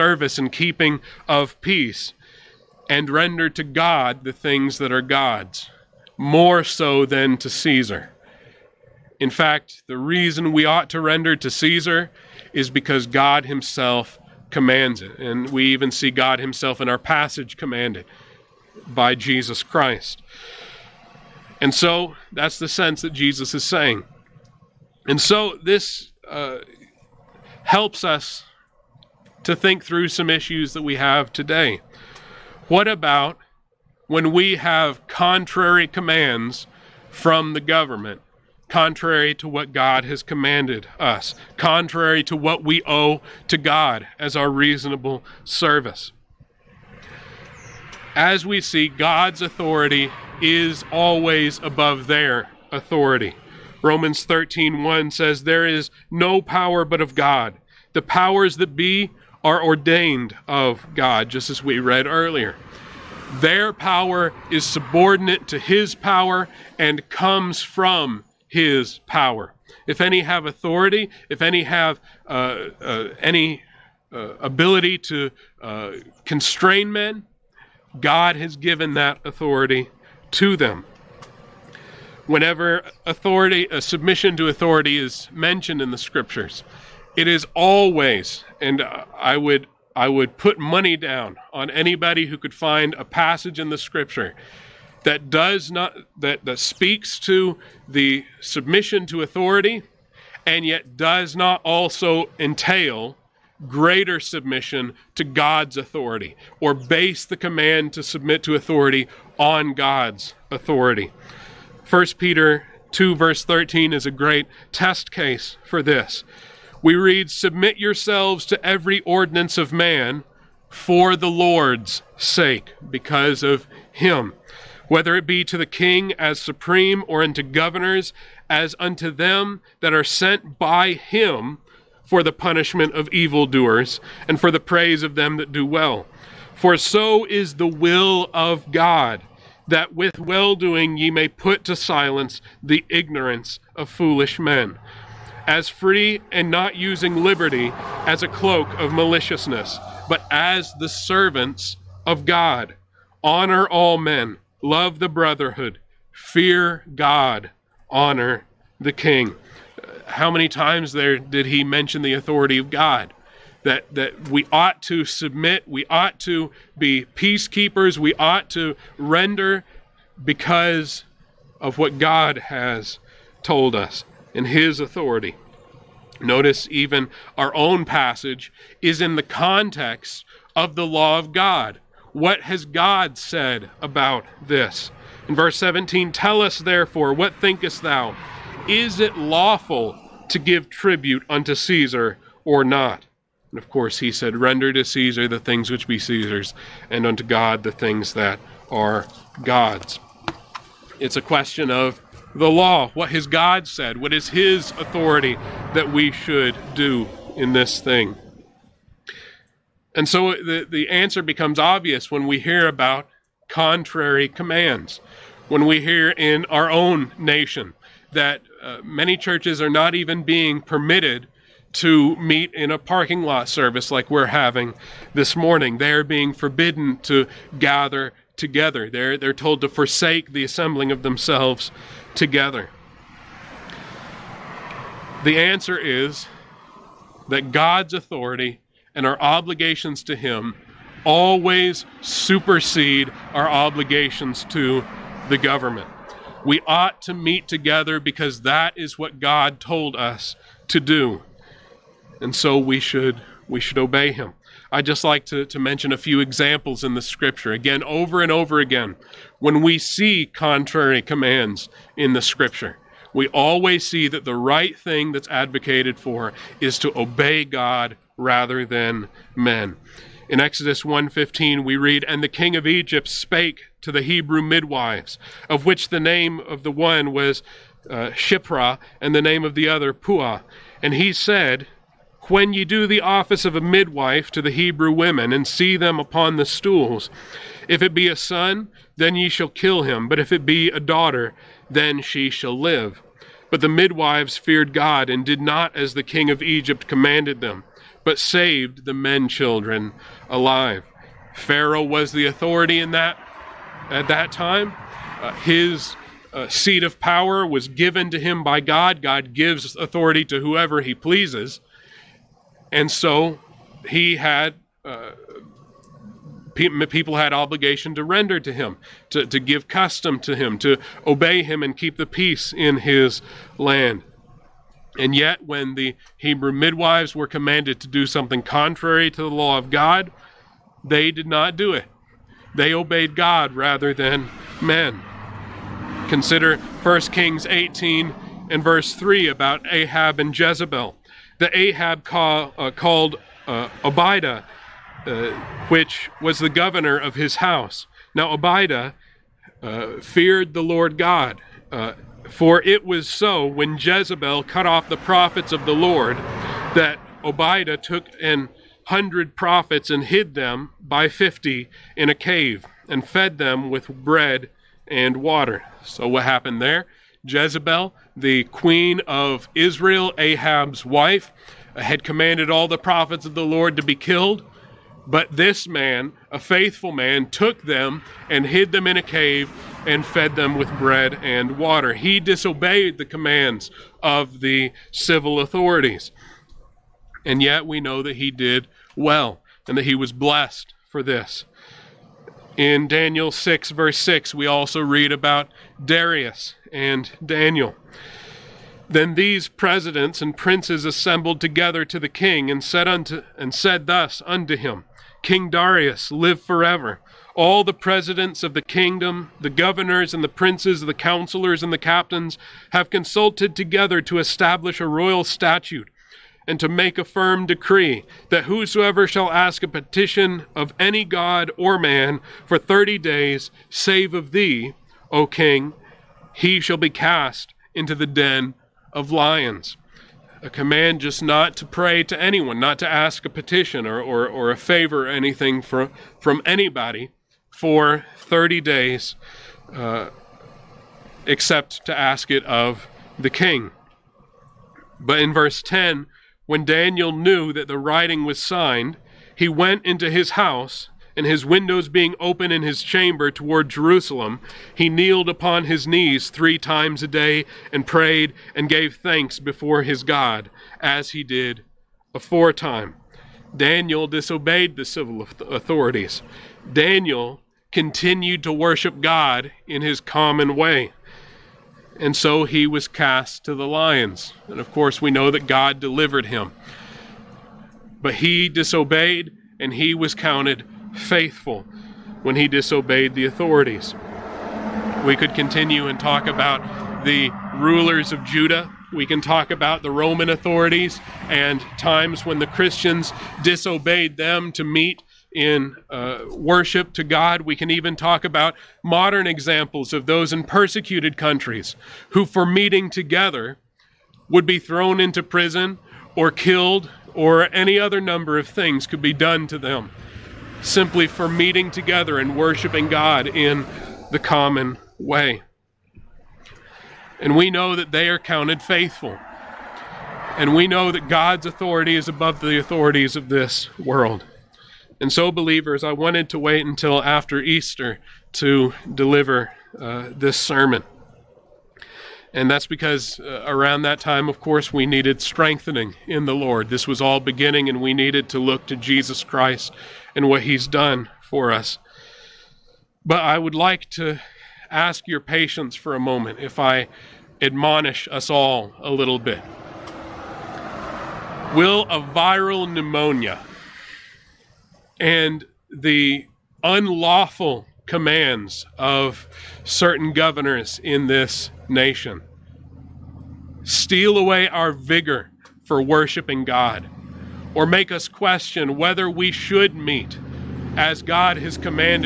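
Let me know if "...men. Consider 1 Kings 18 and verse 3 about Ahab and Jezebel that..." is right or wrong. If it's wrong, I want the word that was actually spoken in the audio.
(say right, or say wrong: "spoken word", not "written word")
right.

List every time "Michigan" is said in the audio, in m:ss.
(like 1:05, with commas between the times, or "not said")
not said.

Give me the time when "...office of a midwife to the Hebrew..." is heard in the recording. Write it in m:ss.
4:42.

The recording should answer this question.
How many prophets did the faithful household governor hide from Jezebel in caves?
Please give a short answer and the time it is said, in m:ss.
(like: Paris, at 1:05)
100, at 5:58.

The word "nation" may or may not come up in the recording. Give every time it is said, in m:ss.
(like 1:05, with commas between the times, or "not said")
3:37, 9:21.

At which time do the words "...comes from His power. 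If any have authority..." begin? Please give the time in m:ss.
1:07.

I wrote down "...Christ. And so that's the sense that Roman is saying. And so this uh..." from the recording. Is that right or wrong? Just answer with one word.
wrong.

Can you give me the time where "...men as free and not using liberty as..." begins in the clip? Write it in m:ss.
2:24.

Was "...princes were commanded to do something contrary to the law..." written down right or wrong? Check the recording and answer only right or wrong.
wrong.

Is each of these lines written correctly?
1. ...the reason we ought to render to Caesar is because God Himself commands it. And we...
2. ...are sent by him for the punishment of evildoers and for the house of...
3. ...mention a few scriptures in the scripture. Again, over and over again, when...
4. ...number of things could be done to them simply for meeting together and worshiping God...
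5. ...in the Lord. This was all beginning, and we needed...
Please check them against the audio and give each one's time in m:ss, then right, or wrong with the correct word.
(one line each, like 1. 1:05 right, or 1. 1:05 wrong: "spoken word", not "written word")
1. 0:09 right
2. 2:09 wrong: "praise", not "house"
3. 4:15 wrong: "examples", not "scriptures"
4. 8:27 right
5. 8:56 right.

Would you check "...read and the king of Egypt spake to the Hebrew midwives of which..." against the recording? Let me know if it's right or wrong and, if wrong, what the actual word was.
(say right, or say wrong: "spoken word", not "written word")
right.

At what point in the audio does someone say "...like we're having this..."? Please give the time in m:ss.
3:43.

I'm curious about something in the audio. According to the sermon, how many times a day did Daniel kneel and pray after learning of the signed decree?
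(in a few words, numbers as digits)
3.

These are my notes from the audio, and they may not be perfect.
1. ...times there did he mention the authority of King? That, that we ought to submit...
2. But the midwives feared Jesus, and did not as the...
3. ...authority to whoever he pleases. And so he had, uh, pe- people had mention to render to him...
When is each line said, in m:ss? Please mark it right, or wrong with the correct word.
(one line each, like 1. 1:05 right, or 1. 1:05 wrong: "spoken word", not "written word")
1. 2:40 wrong: "God", not "King"
2. 4:53 wrong: "God", not "Jesus"
3. 5:09 wrong: "obligation", not "mention".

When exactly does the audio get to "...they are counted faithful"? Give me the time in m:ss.
8:37.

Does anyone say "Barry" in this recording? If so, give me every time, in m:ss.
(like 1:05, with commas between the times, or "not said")
not said.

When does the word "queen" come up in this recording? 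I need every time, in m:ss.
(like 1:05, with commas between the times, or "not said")
6:08.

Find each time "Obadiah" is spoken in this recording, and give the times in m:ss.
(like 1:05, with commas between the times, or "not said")
5:43, 5:48, 5:57.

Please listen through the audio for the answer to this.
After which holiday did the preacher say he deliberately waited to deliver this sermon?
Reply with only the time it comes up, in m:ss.
8:47.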